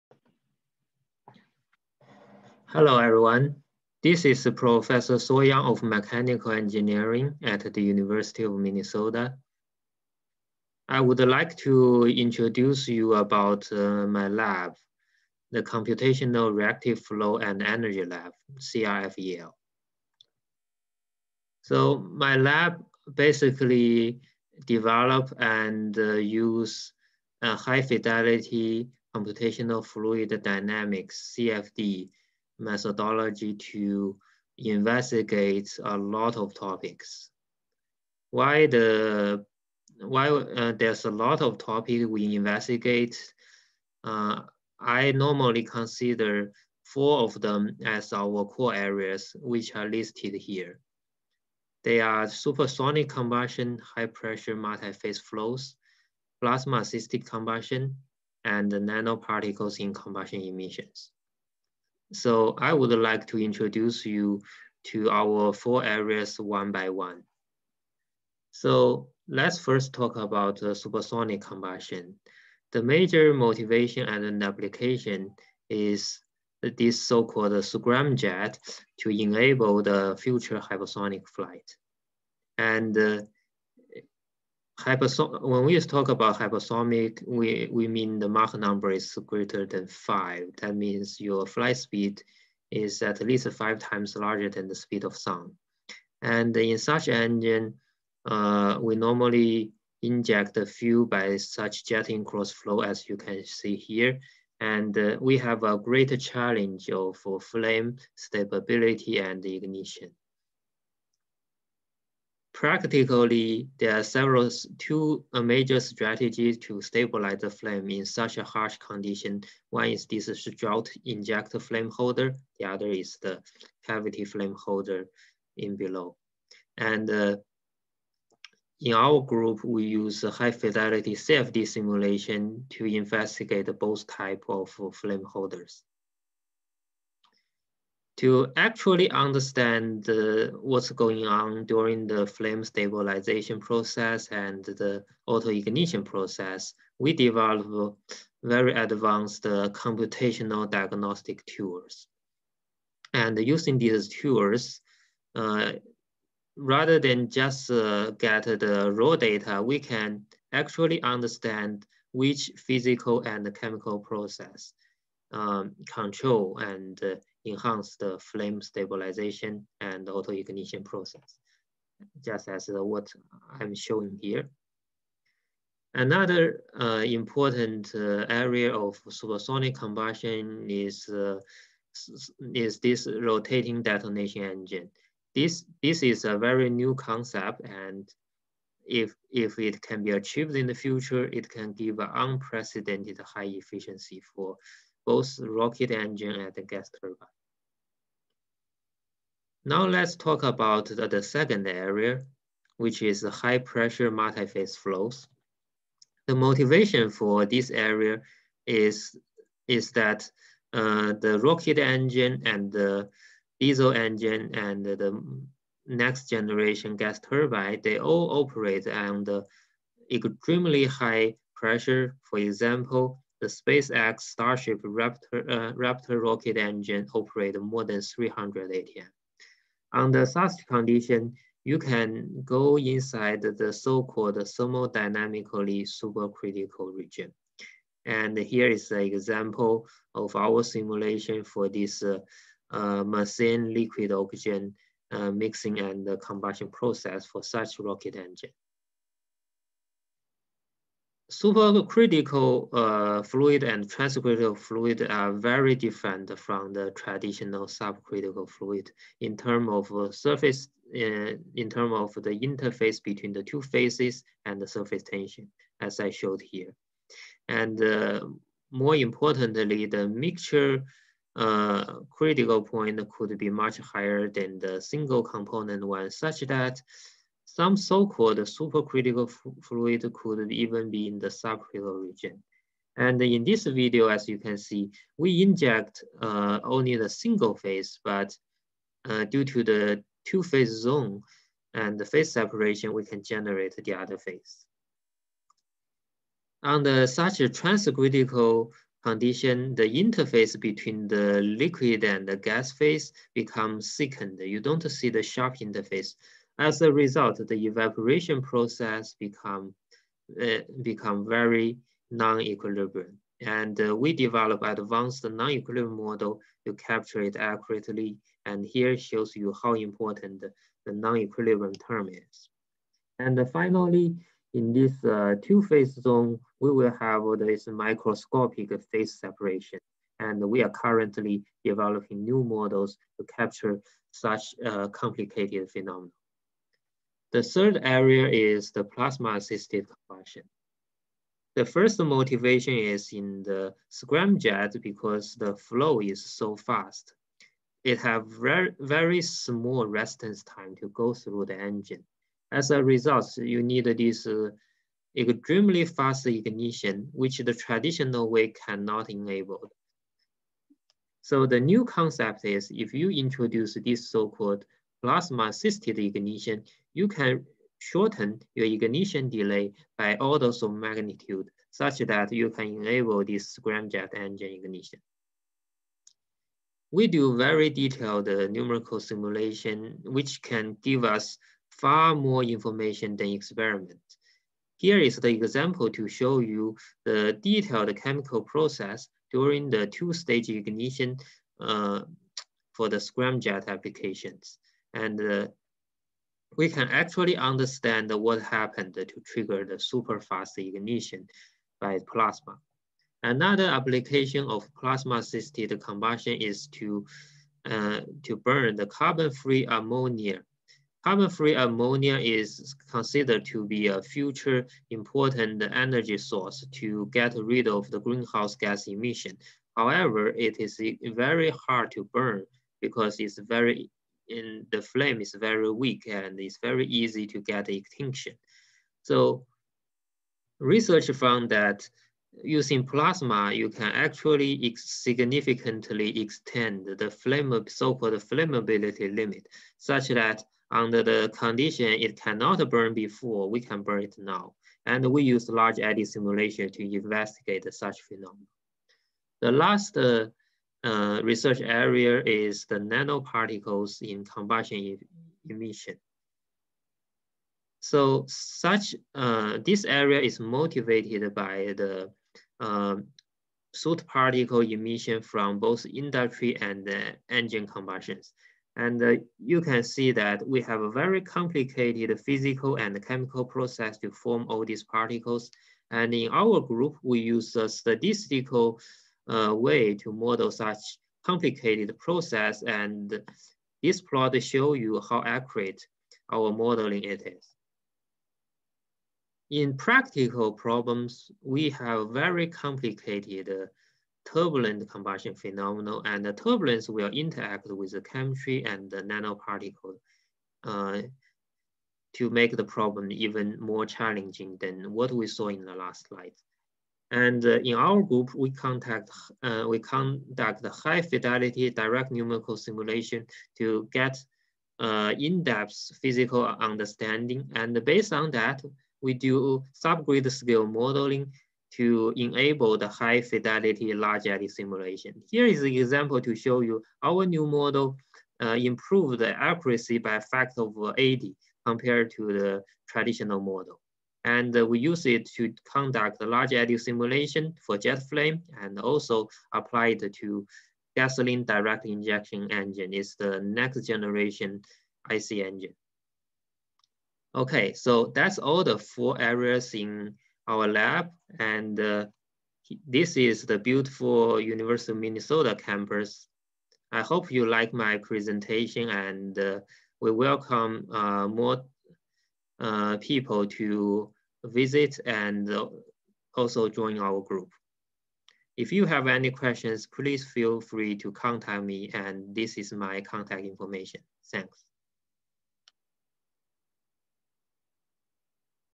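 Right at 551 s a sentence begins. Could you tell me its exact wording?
And uh, this is the beautiful University of Minnesota campus.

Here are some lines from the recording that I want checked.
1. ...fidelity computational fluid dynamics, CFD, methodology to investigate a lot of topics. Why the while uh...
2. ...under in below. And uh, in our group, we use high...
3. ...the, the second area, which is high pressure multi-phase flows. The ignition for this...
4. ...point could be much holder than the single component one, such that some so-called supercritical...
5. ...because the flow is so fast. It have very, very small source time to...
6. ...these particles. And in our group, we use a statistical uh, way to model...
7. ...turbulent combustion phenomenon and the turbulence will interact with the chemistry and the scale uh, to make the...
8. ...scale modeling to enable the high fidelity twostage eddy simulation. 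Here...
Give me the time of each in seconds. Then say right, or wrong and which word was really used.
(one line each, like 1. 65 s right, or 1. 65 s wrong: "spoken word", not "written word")
1. 27 s right
2. 124 s wrong: "holder", not "under"
3. 200 s wrong: "motivation", not "ignition"
4. 272 s wrong: "higher", not "holder"
5. 344 s wrong: "residence", not "source"
6. 474 s right
7. 494 s wrong: "nanoparticle", not "scale"
8. 520 s wrong: "large", not "twostage".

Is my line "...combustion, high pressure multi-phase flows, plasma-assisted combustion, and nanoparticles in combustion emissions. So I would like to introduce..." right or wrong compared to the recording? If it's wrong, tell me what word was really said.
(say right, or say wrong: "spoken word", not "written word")
right.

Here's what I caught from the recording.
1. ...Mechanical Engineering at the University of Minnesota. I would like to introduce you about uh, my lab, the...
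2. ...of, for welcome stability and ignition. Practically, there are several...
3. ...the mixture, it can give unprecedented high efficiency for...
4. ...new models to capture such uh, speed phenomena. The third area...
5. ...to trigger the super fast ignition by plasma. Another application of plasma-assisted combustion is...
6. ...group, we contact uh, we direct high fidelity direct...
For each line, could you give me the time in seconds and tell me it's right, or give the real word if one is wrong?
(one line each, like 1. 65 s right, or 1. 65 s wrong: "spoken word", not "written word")
1. 5 s right
2. 106 s wrong: "flame", not "welcome"
3. 190 s wrong: "future", not "mixture"
4. 332 s wrong: "complicated", not "speed"
5. 398 s right
6. 508 s wrong: "conduct", not "direct".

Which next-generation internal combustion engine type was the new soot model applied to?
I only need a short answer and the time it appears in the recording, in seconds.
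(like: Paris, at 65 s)
gasoline direct injection engine, at 540 s.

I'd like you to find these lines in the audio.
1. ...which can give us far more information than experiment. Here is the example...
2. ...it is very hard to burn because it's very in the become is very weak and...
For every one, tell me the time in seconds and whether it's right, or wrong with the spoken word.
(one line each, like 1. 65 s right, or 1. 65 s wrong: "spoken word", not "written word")
1. 380 s right
2. 420 s wrong: "flame", not "become".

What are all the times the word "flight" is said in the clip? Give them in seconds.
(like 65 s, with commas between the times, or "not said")
81 s, 91 s.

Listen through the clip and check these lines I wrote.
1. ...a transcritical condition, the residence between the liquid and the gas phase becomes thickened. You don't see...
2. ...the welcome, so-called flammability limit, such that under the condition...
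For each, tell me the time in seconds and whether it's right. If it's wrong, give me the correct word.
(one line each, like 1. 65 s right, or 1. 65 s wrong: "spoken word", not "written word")
1. 297 s wrong: "interface", not "residence"
2. 436 s wrong: "flame", not "welcome".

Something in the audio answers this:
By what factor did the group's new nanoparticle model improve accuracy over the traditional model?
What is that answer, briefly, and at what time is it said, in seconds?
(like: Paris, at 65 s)
80, at 530 s.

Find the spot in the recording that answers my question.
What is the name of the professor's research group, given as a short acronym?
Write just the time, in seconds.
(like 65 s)
18 s.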